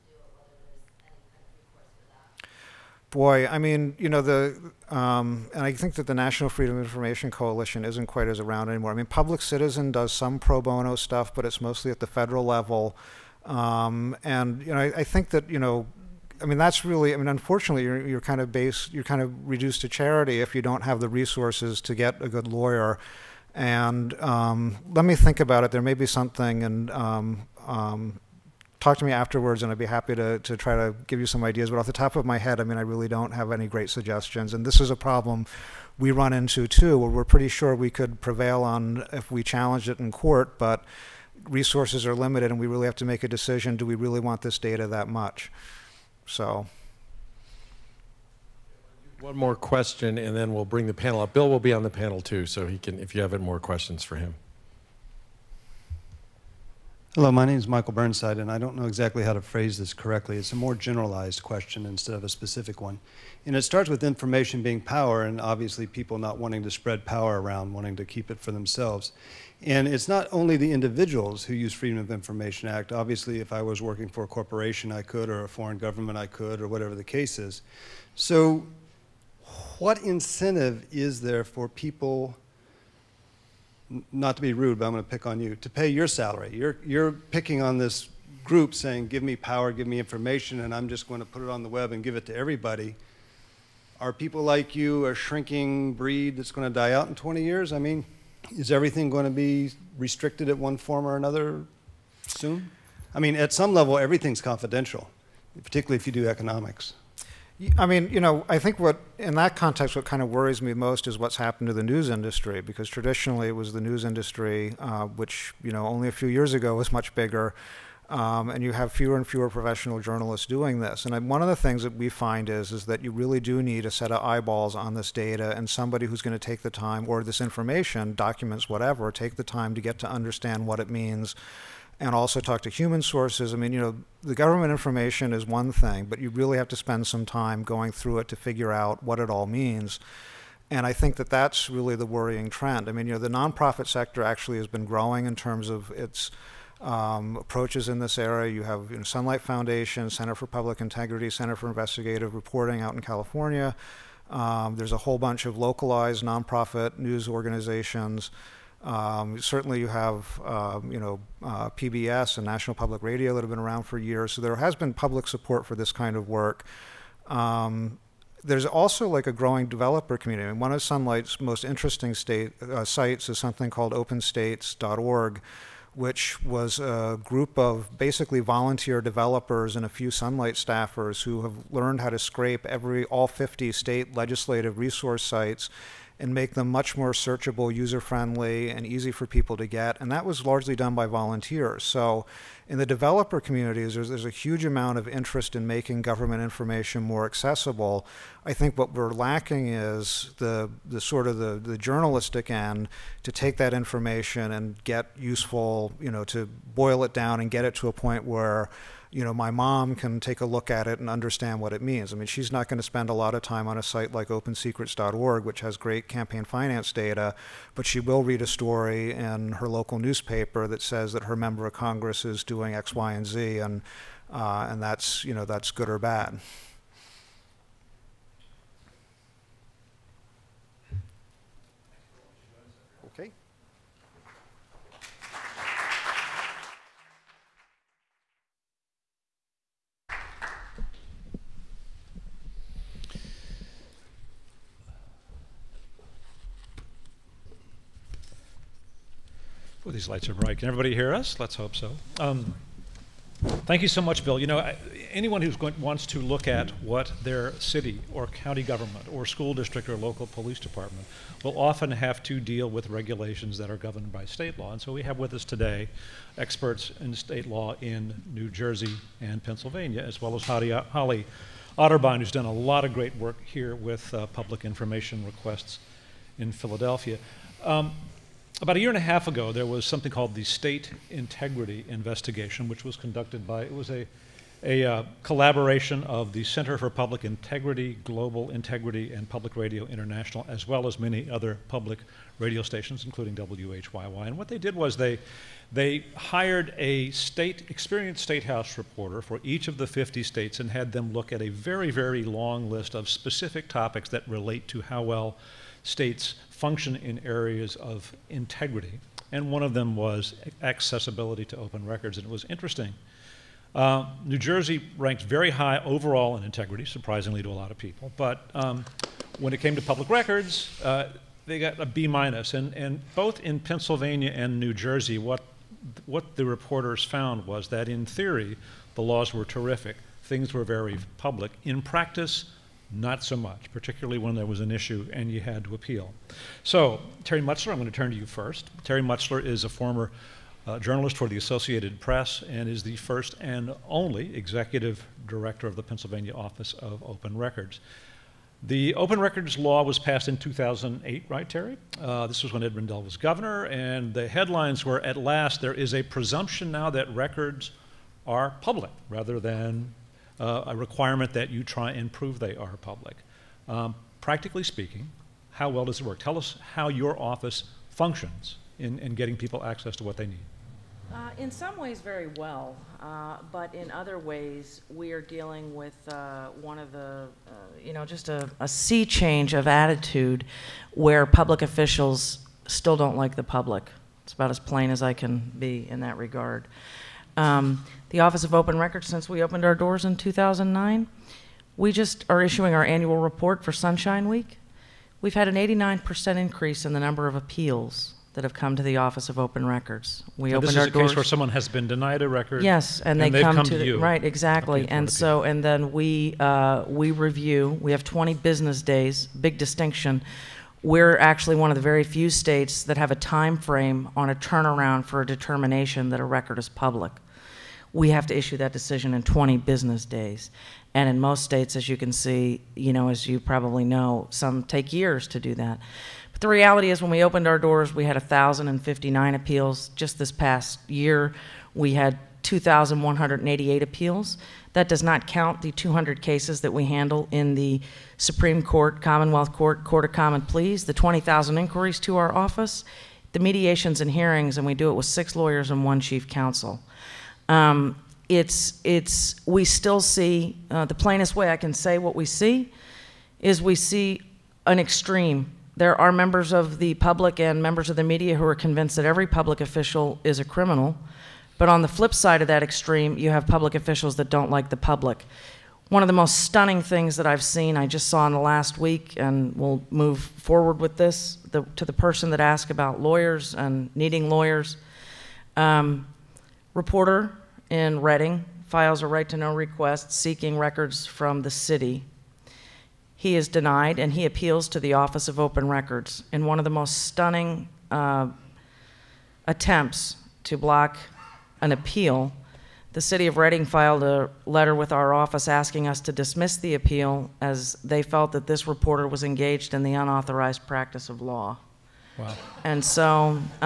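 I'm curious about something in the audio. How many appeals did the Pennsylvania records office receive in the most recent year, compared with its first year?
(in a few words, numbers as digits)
2,188.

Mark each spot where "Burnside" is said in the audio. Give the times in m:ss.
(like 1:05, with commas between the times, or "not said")
0:57.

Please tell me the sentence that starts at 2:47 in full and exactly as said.
Um, there's also like a growing developer community.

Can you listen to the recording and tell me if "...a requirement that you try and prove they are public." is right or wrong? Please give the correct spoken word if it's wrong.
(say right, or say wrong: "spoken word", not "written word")
right.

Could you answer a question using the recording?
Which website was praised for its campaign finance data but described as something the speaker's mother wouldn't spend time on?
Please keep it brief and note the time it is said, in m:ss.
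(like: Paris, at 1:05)
opensecrets.org, at 3:34.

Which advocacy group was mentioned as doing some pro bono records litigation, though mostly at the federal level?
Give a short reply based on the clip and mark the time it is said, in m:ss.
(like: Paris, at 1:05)
Public Citizen, at 0:09.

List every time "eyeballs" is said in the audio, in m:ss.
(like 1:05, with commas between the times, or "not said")
2:04.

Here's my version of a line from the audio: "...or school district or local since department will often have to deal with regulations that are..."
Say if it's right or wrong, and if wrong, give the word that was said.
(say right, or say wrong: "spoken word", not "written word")
wrong: "police", not "since".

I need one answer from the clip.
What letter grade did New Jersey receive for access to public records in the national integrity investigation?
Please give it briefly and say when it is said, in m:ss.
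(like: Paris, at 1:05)
B minus, at 5:21.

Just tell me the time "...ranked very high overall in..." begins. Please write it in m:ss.
5:14.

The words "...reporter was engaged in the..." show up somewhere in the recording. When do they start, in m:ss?
8:18.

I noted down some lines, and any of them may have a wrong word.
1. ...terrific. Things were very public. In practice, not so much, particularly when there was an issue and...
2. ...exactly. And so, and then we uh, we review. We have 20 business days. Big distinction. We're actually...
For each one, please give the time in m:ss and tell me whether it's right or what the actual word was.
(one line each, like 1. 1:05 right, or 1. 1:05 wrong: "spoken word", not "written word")
1. 5:29 right
2. 6:44 right.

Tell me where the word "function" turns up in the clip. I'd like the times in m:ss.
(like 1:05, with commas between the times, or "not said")
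5:06, 6:07.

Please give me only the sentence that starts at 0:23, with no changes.
And um, let me think about it.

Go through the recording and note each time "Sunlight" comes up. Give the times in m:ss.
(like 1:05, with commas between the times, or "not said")
2:29, 2:50, 3:00.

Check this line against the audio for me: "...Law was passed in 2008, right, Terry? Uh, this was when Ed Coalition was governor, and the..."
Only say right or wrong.
wrong.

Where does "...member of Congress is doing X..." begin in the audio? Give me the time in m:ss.
3:41.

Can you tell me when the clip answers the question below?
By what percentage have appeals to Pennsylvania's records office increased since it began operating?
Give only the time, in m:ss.
6:35.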